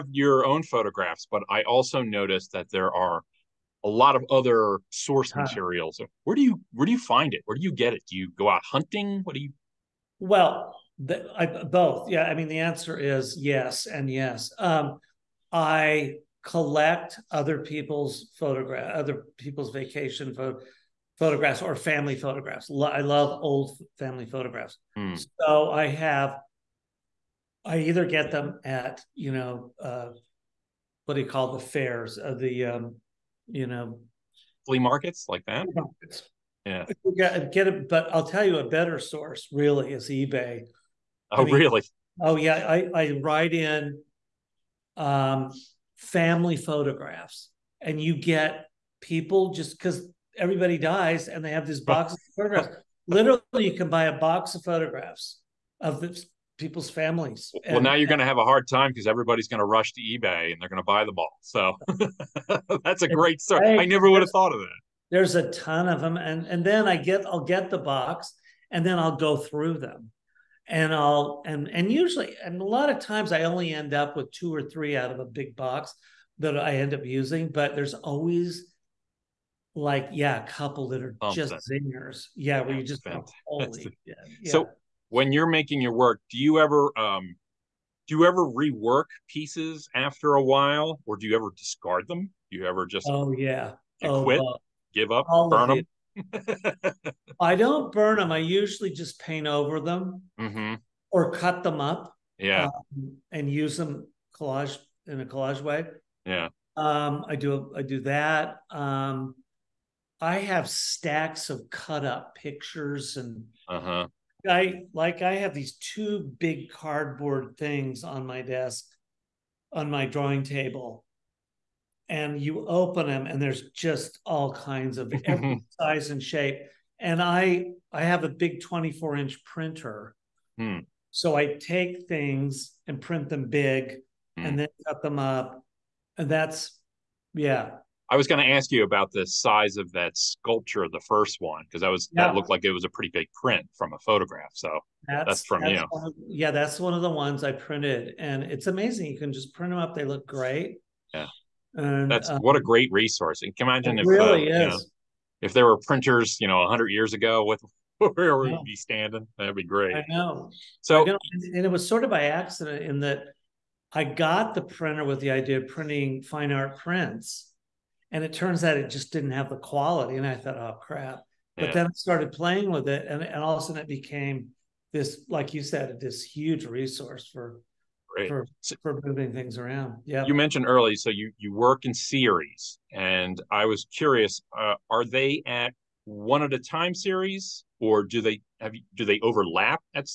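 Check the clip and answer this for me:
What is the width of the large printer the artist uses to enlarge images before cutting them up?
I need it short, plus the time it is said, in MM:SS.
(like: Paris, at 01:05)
24 inch, at 02:08.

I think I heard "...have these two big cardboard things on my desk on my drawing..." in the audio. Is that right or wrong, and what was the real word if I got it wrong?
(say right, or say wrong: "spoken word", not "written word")
right.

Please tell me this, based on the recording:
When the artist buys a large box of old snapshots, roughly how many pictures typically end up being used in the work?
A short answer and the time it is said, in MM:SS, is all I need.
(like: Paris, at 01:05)
2 or 3, at 01:14.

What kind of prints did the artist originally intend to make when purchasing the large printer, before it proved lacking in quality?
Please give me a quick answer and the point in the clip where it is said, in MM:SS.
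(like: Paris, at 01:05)
fine art prints, at 02:46.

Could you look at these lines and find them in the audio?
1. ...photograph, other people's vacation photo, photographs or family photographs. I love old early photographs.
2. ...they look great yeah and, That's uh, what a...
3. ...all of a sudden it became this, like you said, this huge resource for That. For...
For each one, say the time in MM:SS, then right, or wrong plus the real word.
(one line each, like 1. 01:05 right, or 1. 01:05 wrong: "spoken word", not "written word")
1. 00:18 wrong: "family", not "early"
2. 02:29 right
3. 02:53 wrong: "Great", not "That".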